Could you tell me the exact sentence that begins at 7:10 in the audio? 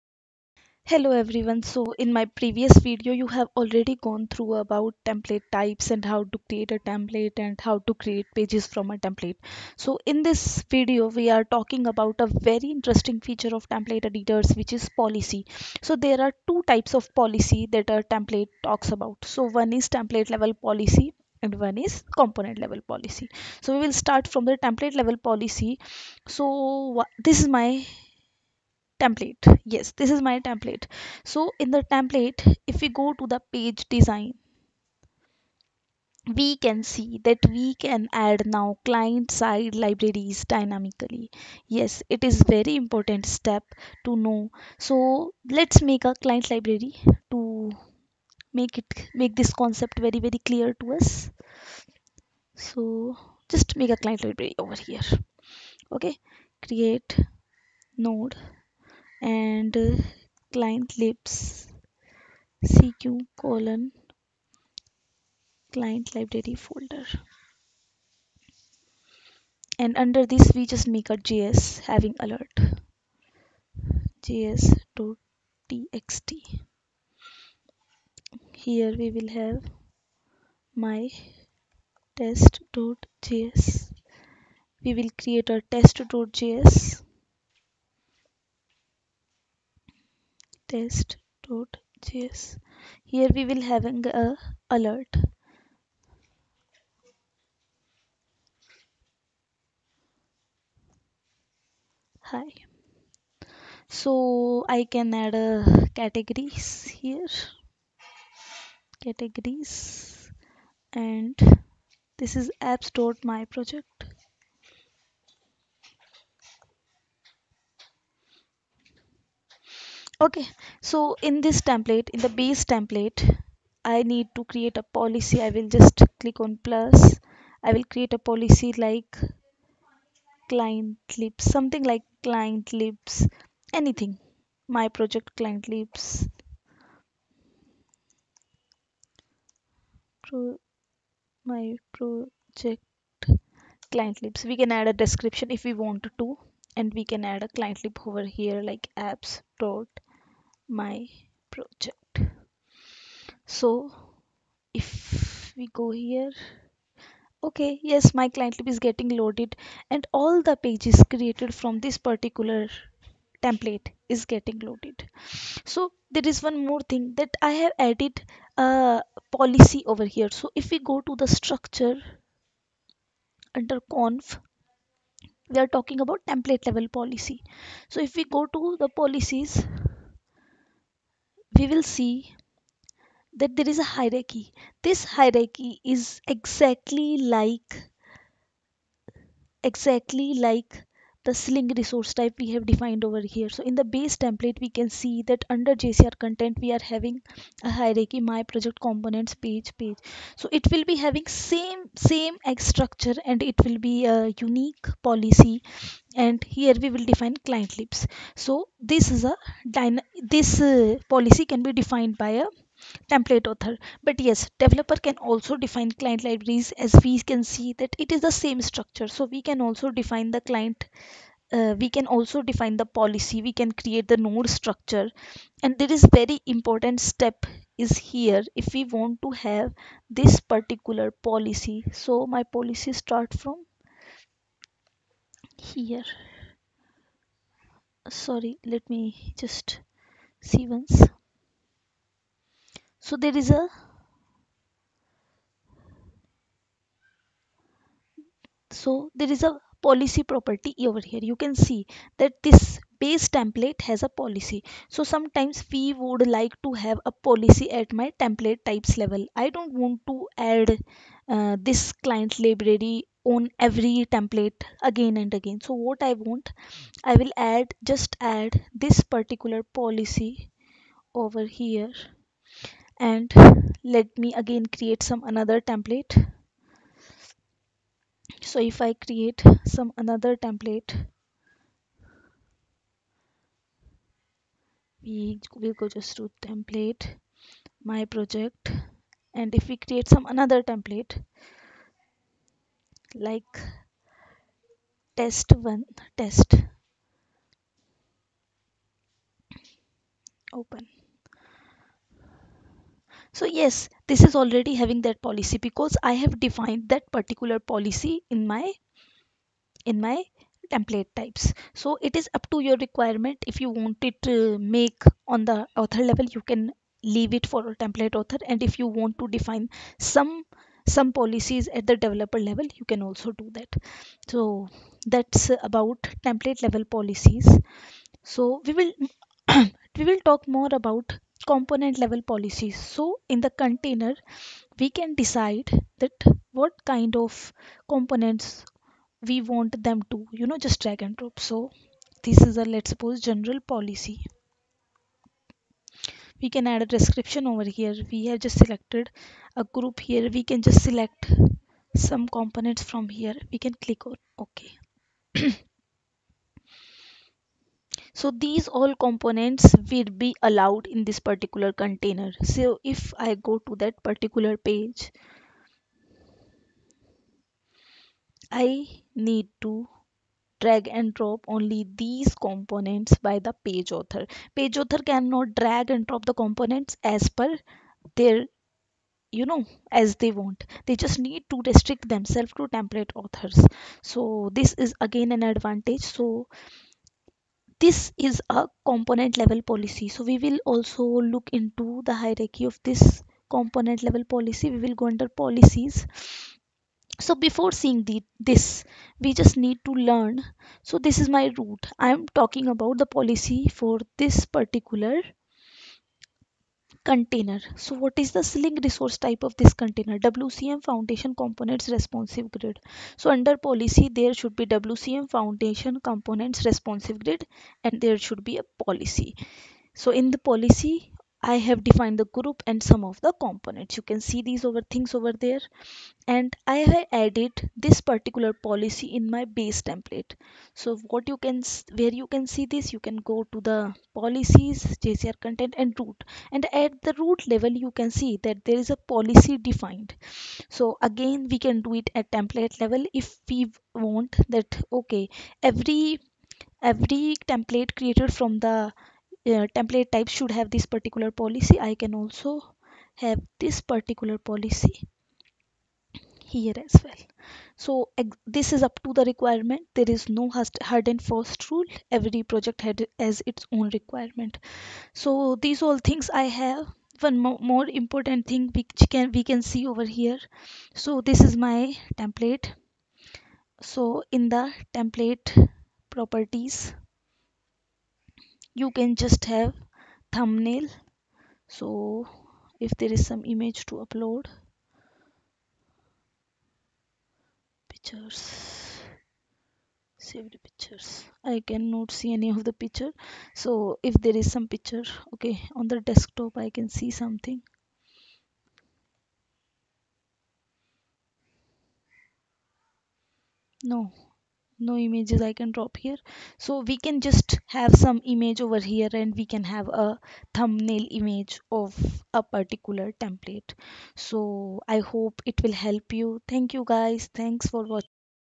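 So what you can, where you can see this, you can go to the policies, JCR content and root.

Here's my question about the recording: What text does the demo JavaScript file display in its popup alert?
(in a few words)
Hi.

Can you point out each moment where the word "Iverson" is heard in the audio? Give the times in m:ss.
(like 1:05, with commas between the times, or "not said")
not said.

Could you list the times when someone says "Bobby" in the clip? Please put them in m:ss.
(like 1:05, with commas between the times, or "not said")
not said.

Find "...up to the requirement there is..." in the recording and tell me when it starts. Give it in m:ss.
7:38.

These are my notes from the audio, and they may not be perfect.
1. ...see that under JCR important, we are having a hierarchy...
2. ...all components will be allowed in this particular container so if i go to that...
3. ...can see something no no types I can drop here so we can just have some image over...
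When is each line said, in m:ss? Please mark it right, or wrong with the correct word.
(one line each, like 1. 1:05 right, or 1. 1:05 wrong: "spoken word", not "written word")
1. 3:14 wrong: "content", not "important"
2. 5:58 right
3. 8:16 wrong: "images", not "types".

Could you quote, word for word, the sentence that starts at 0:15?
So there are two types of policy that a template talks about.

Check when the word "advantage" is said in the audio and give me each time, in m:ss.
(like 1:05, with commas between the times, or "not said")
6:25.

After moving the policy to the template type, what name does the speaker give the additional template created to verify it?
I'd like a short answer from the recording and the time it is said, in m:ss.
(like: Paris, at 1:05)
test one, at 4:55.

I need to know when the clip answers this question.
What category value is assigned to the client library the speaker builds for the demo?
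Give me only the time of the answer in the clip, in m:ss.
1:52.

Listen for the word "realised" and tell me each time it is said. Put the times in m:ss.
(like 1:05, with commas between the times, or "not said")
not said.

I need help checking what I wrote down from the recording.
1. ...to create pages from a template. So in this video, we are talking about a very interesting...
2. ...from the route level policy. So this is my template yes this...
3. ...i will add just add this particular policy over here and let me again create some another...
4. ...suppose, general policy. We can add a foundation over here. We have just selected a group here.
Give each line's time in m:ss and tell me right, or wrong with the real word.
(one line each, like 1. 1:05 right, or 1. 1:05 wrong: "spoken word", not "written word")
1. 0:07 right
2. 0:24 wrong: "template", not "route"
3. 4:27 right
4. 5:42 wrong: "description", not "foundation".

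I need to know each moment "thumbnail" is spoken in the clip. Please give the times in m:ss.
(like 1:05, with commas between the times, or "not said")
8:00, 8:30.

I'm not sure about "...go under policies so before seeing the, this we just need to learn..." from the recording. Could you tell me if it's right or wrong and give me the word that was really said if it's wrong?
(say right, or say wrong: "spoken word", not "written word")
right.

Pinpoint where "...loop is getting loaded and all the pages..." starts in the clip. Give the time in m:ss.
2:38.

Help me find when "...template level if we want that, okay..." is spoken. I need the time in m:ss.
7:22.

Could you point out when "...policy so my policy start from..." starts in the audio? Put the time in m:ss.
3:51.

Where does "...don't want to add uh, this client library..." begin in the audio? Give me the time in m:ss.
4:19.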